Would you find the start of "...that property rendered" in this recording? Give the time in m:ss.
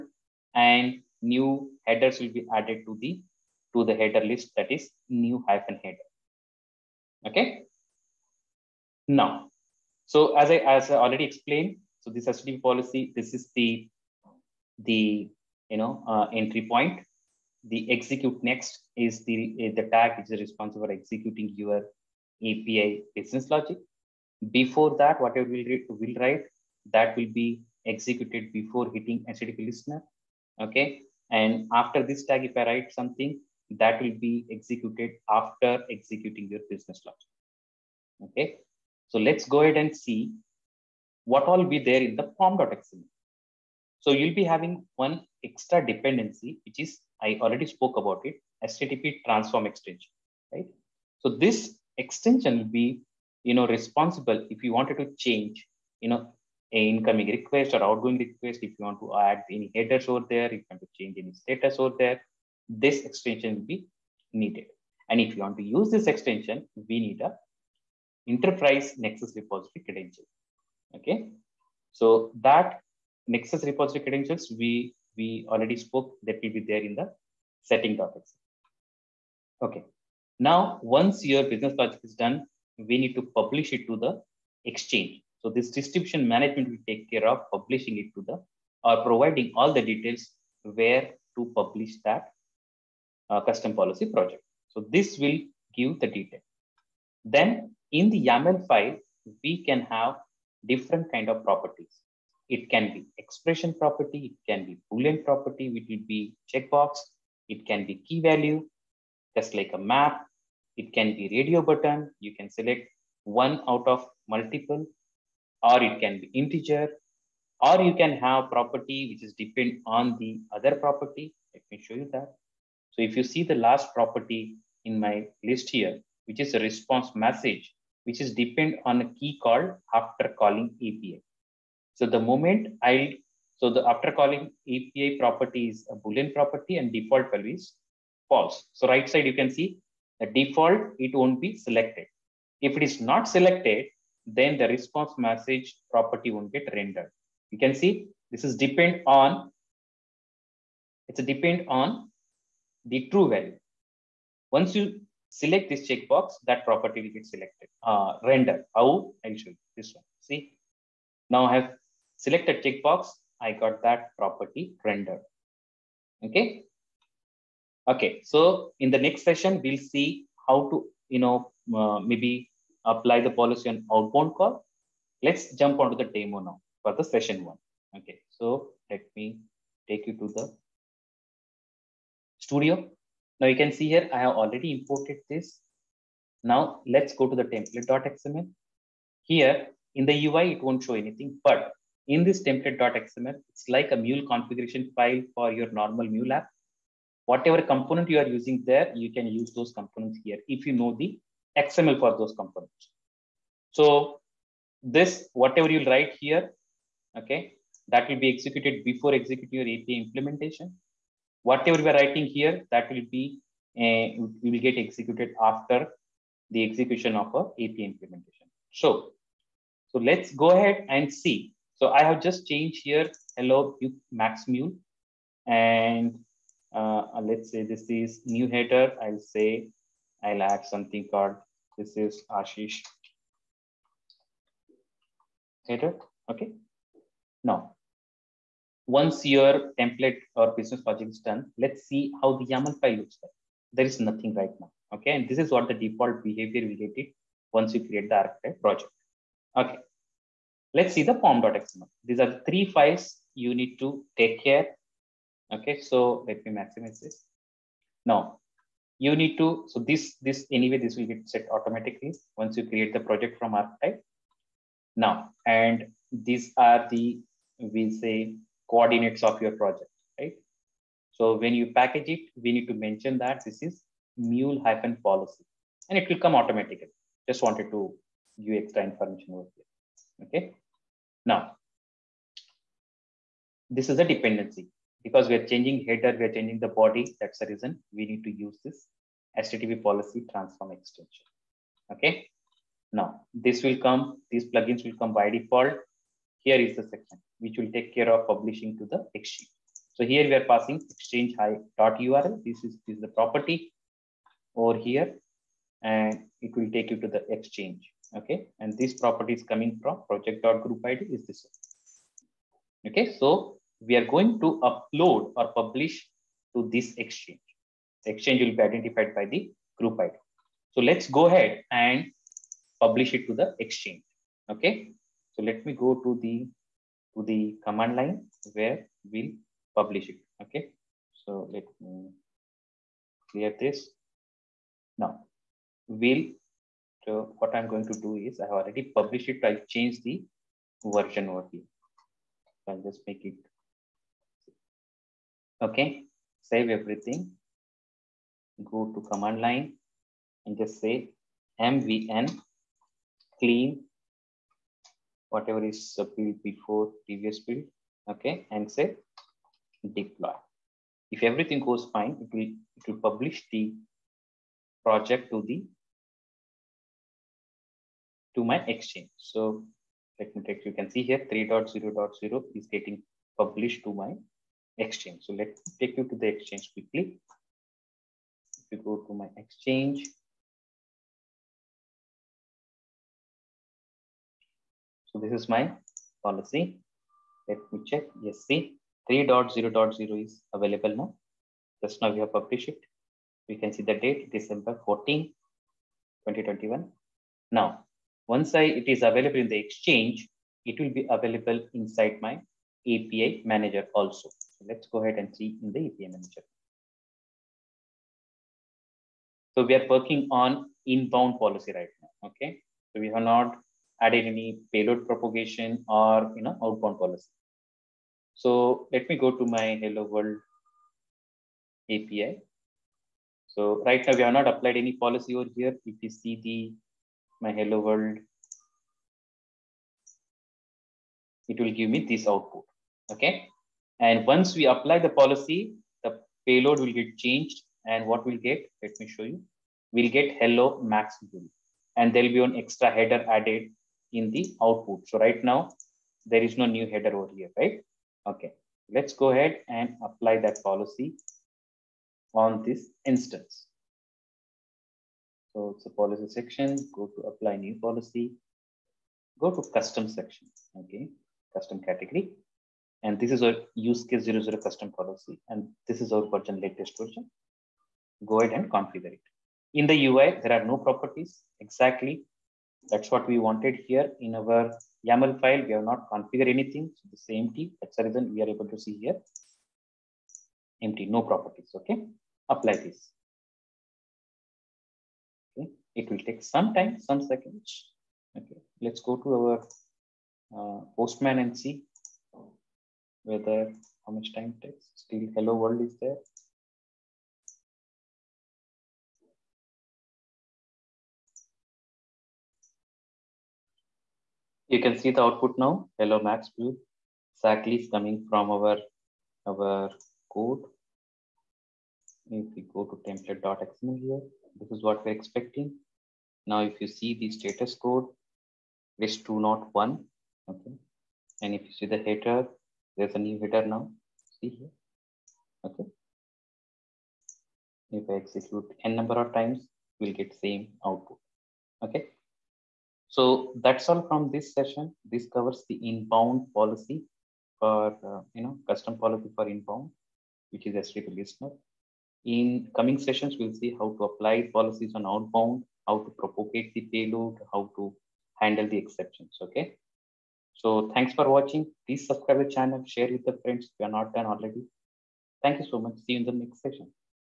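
2:43.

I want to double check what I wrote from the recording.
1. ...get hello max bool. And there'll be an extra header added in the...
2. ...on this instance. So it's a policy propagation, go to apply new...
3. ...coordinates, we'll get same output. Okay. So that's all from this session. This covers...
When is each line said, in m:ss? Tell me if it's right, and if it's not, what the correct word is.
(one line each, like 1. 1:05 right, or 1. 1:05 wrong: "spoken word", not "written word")
1. 7:20 right
2. 7:32 wrong: "section", not "propagation"
3. 8:49 wrong: "times", not "coordinates".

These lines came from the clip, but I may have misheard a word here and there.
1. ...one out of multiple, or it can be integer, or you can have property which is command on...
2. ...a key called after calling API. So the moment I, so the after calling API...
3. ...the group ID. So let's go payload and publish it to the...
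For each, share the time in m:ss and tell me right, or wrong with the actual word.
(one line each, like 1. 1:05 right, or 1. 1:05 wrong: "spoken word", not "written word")
1. 1:53 wrong: "depend", not "command"
2. 2:09 right
3. 5:19 wrong: "ahead", not "payload".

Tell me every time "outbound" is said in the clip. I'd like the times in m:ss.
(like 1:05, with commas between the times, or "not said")
2:53, 6:56, 9:05.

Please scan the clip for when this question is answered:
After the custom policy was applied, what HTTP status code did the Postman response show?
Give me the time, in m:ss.
8:39.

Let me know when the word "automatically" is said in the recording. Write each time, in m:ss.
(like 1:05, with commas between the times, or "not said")
4:21, 4:36.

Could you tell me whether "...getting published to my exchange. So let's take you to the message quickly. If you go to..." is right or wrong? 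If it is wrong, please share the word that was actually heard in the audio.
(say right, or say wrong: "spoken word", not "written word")
wrong: "exchange", not "message".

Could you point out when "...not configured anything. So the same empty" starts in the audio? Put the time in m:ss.
7:55.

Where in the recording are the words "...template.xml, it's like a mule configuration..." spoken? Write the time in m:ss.
3:12.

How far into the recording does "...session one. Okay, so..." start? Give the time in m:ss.
2:57.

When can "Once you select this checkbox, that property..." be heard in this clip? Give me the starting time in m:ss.
2:34.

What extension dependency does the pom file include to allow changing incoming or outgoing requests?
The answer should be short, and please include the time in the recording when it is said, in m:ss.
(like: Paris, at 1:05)
HTTP transform extension, at 0:48.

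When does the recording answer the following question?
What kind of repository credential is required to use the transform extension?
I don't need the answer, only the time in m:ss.
1:08.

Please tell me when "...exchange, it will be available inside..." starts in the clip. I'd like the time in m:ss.
6:39.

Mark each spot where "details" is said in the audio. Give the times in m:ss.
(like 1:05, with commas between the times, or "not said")
1:29, 1:36.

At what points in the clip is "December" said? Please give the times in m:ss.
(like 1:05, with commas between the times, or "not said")
6:34.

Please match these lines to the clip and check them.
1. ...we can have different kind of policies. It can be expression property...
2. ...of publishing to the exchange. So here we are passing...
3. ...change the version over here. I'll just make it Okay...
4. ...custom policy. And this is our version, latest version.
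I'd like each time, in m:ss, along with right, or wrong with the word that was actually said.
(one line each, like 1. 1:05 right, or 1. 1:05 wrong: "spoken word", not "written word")
1. 1:39 wrong: "properties", not "policies"
2. 4:58 right
3. 5:39 right
4. 7:44 right.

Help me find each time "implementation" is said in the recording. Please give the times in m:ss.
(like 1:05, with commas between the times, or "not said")
3:30, 3:37.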